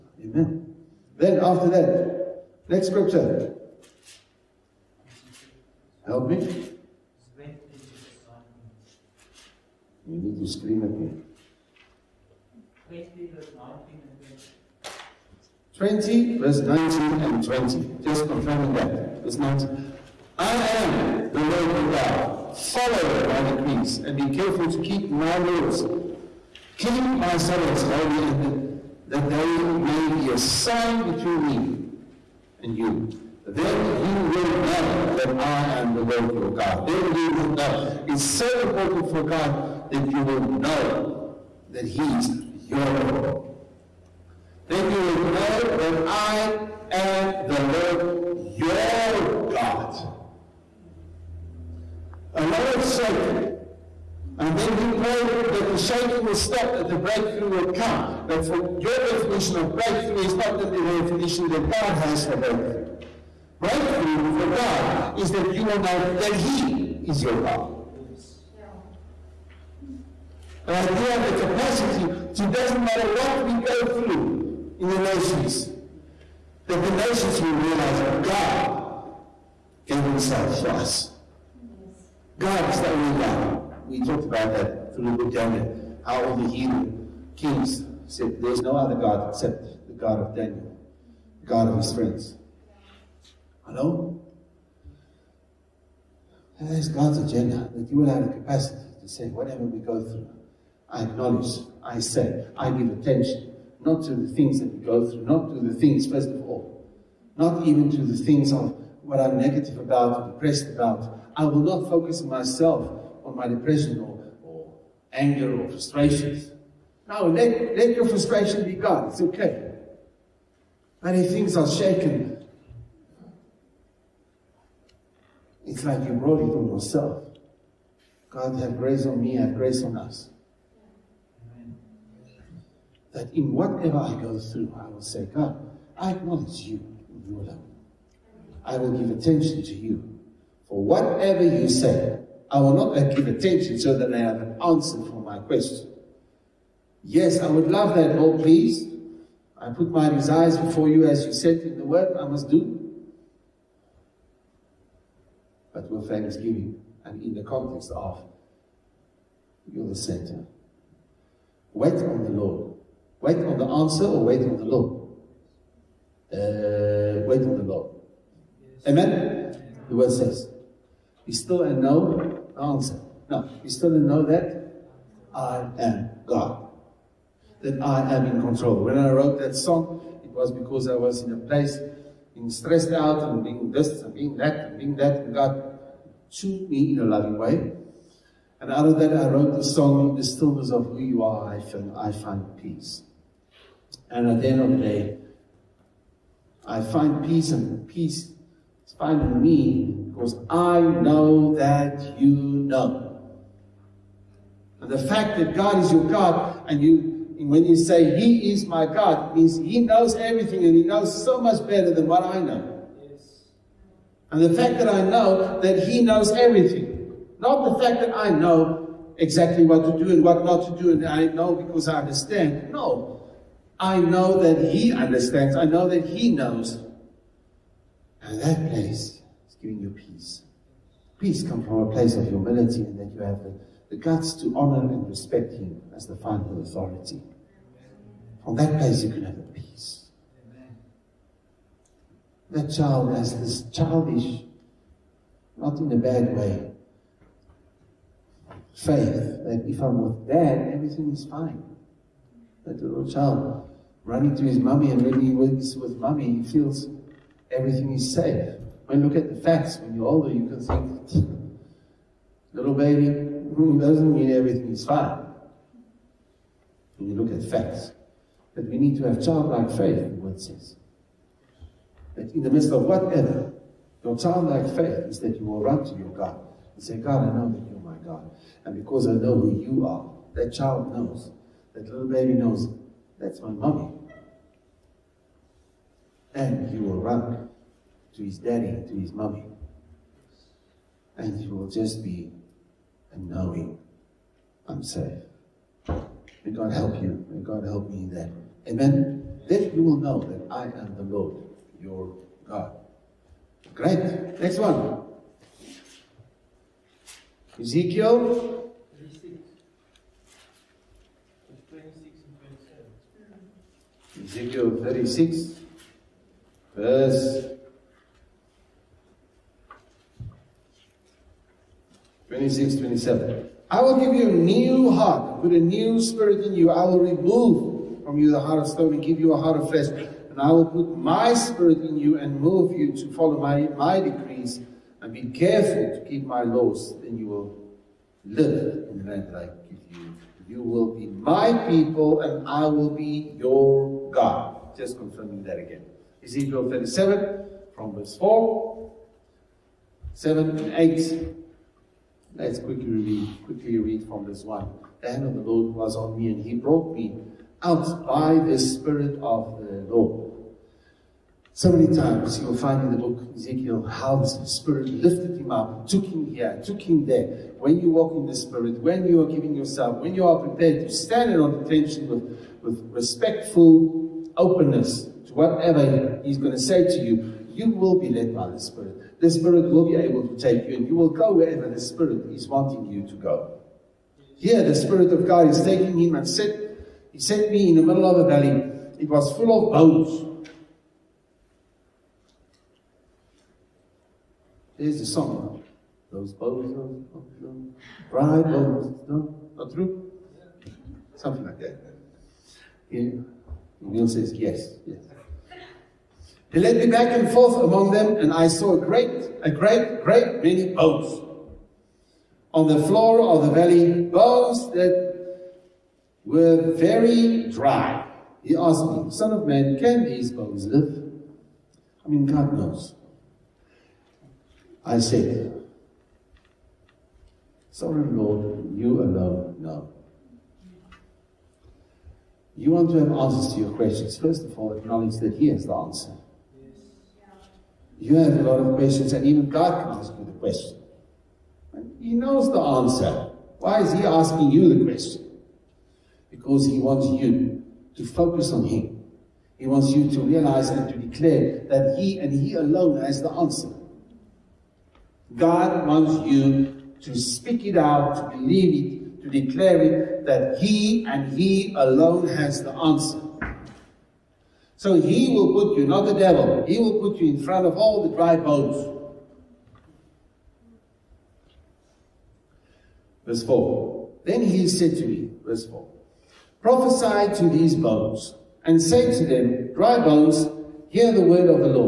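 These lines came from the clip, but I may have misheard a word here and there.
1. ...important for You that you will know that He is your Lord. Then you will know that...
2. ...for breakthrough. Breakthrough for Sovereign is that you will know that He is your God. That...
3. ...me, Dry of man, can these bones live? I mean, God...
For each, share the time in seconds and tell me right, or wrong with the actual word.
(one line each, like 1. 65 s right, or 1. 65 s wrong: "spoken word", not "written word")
1. 38 s wrong: "God", not "You"
2. 62 s wrong: "God", not "Sovereign"
3. 418 s wrong: "Son", not "Dry".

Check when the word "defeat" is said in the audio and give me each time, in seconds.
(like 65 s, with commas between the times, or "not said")
not said.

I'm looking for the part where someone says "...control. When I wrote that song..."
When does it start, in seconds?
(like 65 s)
178 s.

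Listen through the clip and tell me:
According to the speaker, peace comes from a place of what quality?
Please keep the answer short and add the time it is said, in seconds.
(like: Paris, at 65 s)
humility, at 232 s.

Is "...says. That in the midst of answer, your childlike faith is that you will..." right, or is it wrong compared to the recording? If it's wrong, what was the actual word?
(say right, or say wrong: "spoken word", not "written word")
wrong: "whatever", not "answer".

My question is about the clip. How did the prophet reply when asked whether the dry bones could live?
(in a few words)
Sovereign Lord, you alone know.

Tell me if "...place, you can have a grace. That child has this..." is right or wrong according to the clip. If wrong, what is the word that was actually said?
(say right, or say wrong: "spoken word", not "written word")
wrong: "peace", not "grace".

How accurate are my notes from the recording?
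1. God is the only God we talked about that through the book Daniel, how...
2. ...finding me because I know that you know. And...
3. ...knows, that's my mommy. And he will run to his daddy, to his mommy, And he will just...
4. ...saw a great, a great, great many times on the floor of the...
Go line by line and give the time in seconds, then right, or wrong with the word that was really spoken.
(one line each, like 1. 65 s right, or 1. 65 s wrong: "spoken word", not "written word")
1. 82 s right
2. 198 s right
3. 282 s right
4. 408 s wrong: "bones", not "times".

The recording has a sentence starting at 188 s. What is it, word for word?
And out of that, I wrote the song, The Stillness of Who You Are, I Find, I find Peace.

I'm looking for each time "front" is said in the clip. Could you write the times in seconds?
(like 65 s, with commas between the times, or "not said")
467 s.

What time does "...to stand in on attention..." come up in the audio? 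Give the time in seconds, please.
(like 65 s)
370 s.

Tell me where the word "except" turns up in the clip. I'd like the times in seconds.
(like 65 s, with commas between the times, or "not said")
89 s.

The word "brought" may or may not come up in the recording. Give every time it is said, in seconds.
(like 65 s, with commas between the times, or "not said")
126 s, 356 s.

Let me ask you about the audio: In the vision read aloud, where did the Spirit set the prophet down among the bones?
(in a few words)
a valley.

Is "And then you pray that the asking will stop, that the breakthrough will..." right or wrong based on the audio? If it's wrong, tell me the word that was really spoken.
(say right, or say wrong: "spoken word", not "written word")
wrong: "shaking", not "asking".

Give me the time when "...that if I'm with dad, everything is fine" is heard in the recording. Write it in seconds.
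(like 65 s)
249 s.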